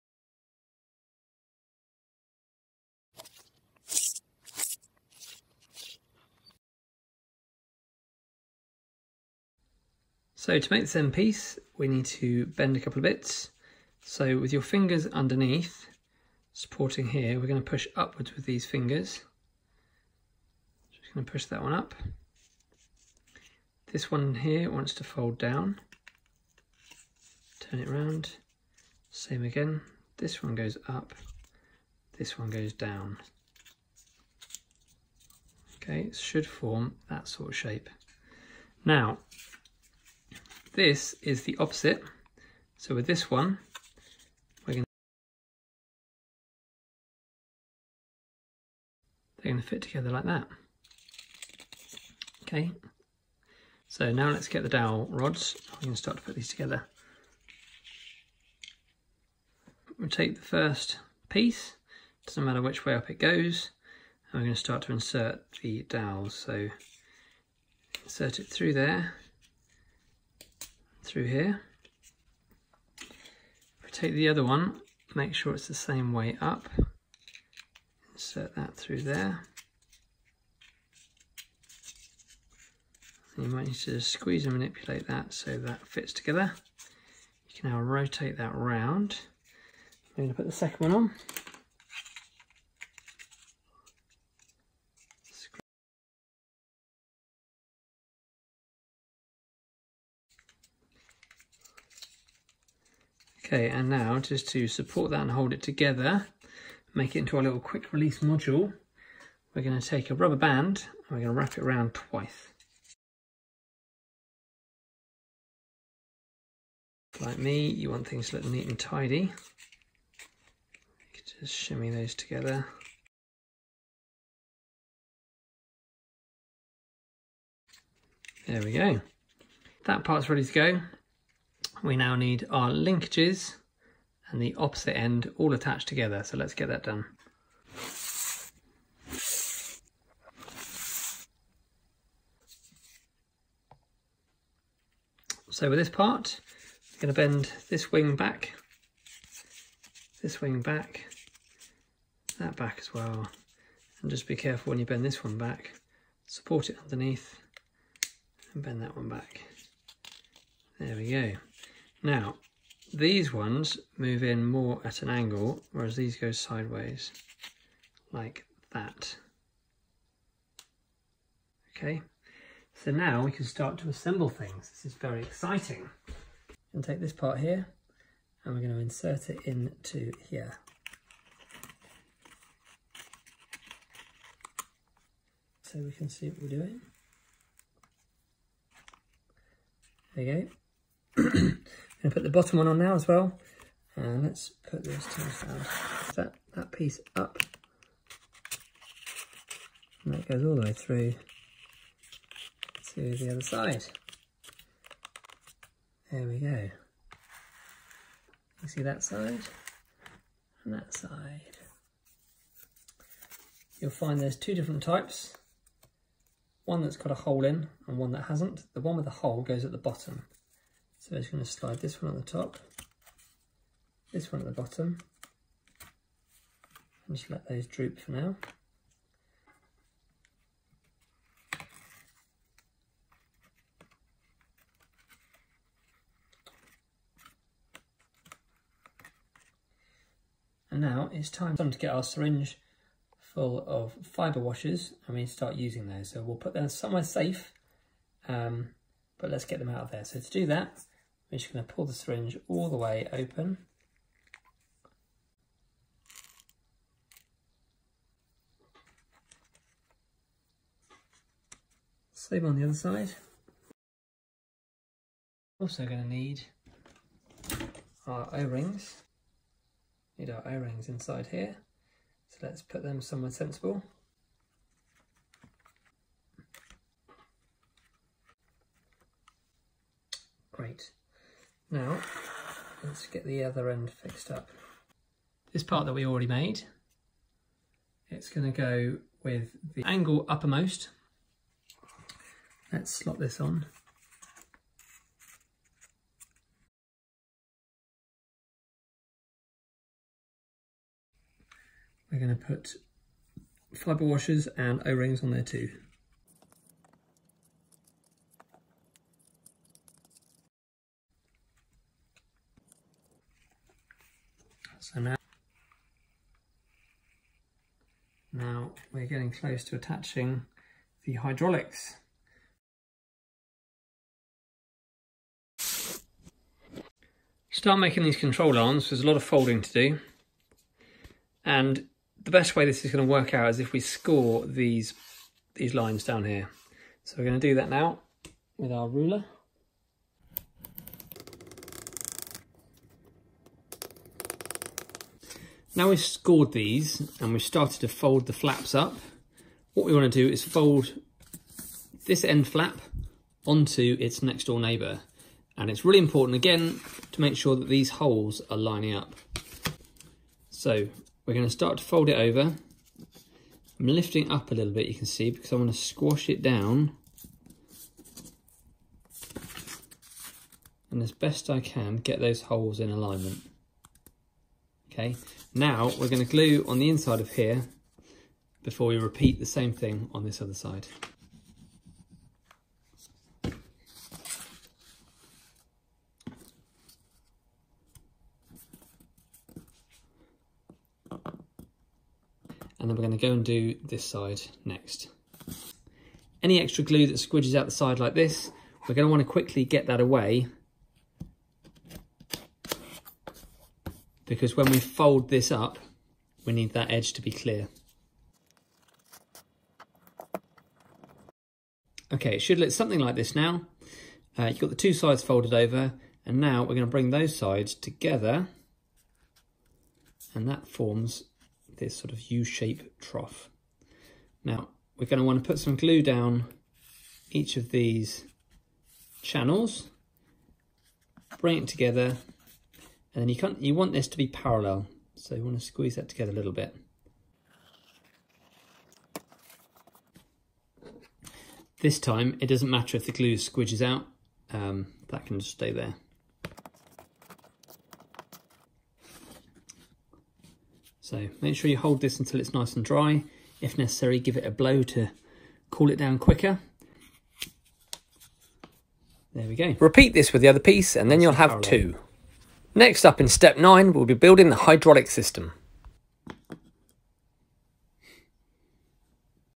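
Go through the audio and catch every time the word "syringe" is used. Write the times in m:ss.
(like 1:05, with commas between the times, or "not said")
4:02, 4:11.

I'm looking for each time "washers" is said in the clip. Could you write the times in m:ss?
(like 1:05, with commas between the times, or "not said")
4:04, 5:04.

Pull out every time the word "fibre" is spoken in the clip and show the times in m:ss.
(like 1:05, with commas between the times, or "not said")
4:04, 5:03.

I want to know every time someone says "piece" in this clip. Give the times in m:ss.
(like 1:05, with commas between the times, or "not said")
0:11, 1:01, 3:16, 7:40.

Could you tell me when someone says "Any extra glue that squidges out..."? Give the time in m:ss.
6:36.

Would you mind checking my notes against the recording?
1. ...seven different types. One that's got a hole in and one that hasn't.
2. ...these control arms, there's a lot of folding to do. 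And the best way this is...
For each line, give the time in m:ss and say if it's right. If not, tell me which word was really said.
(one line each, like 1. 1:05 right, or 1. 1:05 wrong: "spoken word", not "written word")
1. 3:34 wrong: "two", not "seven"
2. 5:28 right.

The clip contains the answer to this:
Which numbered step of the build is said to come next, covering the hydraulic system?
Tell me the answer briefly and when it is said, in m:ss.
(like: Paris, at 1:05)
step 9, at 7:43.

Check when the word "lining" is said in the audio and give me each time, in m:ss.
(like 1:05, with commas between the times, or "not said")
5:58.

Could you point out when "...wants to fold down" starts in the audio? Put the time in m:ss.
0:24.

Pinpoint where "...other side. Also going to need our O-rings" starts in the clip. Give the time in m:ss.
4:22.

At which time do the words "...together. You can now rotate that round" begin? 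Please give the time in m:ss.
1:26.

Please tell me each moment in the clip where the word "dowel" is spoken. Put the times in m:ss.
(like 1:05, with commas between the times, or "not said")
0:54, 1:05.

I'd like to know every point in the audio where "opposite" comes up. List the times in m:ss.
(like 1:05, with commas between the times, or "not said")
0:41, 2:14.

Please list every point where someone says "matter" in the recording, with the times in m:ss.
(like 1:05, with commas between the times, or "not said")
1:02, 7:22.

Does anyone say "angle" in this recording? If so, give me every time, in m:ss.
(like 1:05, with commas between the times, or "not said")
2:45, 4:49.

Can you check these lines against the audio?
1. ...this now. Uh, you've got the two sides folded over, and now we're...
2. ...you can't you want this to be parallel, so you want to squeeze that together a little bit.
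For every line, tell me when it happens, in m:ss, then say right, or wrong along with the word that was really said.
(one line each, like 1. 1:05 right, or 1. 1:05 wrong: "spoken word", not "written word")
1. 6:53 right
2. 7:13 right.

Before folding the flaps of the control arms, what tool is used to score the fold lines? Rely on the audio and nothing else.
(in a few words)
ruler.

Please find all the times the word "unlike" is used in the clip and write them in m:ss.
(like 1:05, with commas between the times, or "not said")
not said.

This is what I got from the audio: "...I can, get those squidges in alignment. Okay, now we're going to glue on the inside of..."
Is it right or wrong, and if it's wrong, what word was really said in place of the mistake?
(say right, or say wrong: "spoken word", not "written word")
wrong: "holes", not "squidges".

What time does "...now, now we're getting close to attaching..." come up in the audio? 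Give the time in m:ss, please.
5:14.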